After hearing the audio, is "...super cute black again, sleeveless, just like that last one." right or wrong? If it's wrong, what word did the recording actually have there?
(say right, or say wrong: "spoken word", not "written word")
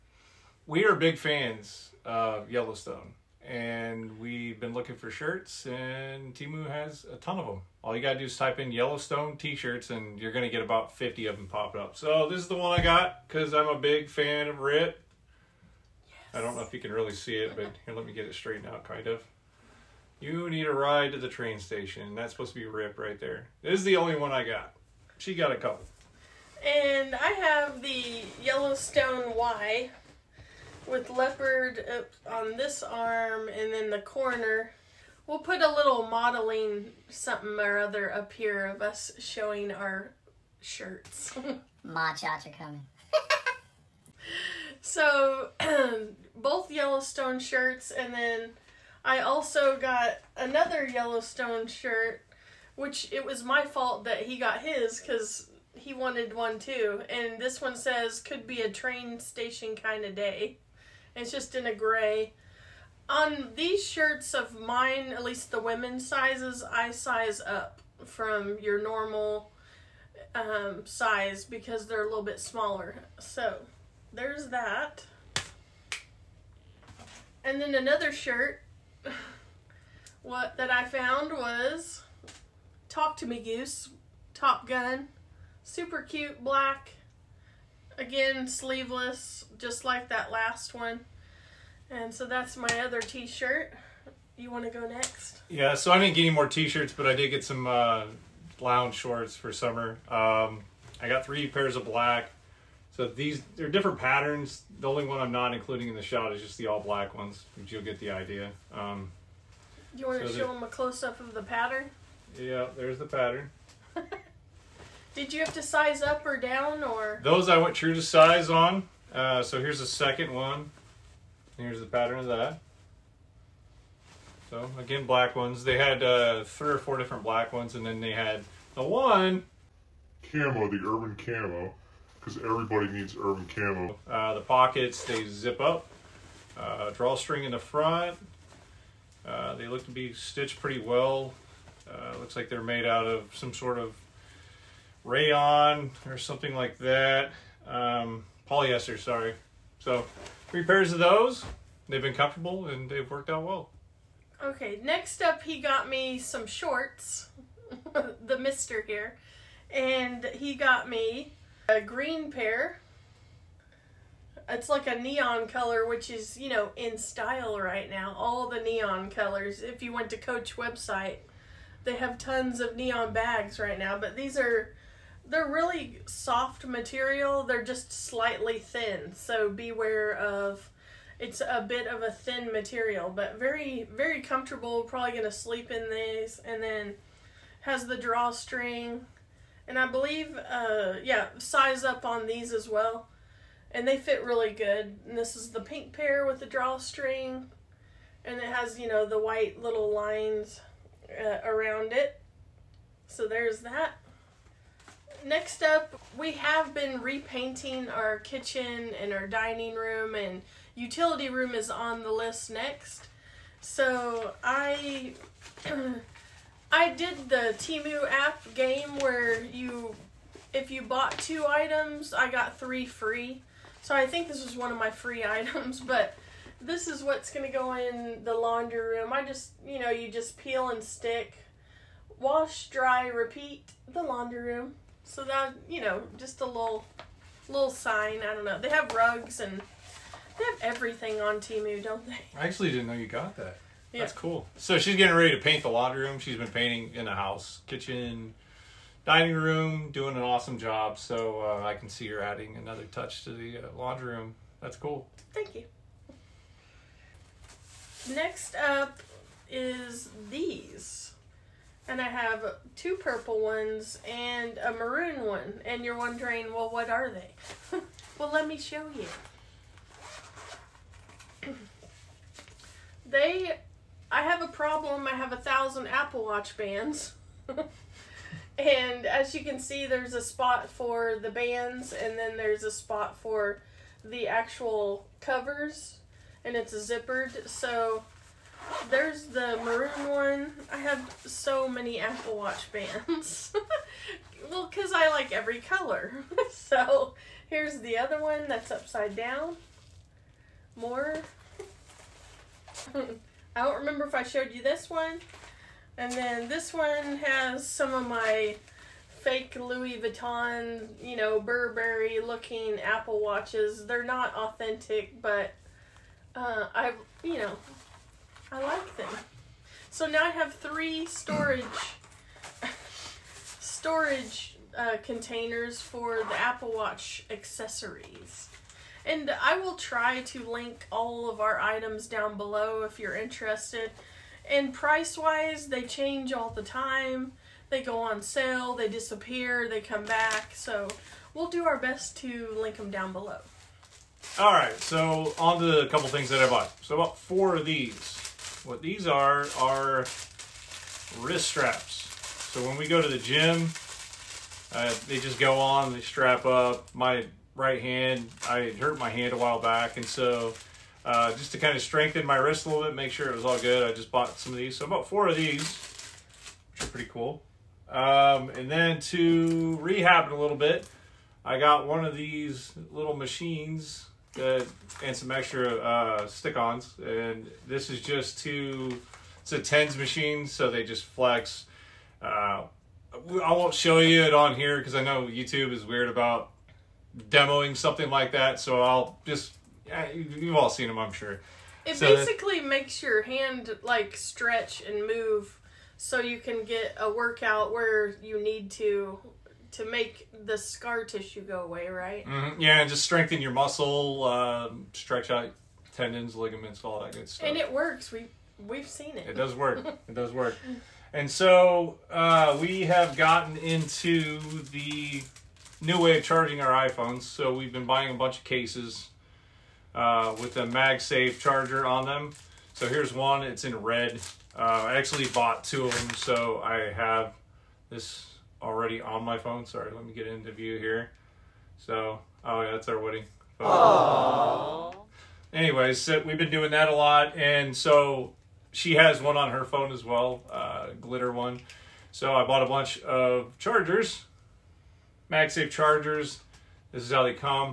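right.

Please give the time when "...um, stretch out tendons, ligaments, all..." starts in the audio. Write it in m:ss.
6:44.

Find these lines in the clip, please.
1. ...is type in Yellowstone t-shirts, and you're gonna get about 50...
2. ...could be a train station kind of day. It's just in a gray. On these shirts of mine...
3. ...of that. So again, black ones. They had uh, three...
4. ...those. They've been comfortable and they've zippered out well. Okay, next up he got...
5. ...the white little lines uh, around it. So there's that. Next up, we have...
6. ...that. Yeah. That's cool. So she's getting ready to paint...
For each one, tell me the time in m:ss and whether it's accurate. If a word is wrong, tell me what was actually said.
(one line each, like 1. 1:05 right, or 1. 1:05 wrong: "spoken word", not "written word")
1. 0:08 right
2. 0:58 right
3. 2:02 right
4. 2:30 wrong: "worked", not "zippered"
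5. 3:19 right
6. 4:03 right.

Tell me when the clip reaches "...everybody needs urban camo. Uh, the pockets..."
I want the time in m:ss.
2:12.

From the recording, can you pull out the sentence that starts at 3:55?
So that you know, just a little little sign.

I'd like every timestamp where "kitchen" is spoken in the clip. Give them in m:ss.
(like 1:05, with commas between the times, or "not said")
3:28, 4:07.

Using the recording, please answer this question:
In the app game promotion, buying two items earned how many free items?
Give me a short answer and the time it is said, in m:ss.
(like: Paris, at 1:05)
3, at 3:42.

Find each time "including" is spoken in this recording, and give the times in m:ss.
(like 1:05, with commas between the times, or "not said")
1:45.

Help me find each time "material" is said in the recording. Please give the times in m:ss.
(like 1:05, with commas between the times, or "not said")
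2:56, 3:02.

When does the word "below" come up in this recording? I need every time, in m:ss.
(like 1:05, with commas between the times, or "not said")
5:32, 5:43.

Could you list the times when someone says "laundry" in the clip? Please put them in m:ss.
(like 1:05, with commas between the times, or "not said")
3:48, 3:54, 4:05, 4:13.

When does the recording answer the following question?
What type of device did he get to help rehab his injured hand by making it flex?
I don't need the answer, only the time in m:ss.
6:19.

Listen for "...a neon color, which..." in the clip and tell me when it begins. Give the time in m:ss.
2:44.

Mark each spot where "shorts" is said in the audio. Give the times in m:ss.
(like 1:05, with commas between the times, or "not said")
1:38, 2:36.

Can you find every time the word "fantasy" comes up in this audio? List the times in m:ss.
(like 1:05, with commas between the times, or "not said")
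not said.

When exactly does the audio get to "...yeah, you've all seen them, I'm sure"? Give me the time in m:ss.
6:29.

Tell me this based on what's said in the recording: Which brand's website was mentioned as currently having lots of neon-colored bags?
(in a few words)
Coach.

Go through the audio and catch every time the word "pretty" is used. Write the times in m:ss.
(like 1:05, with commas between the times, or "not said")
2:20, 6:06.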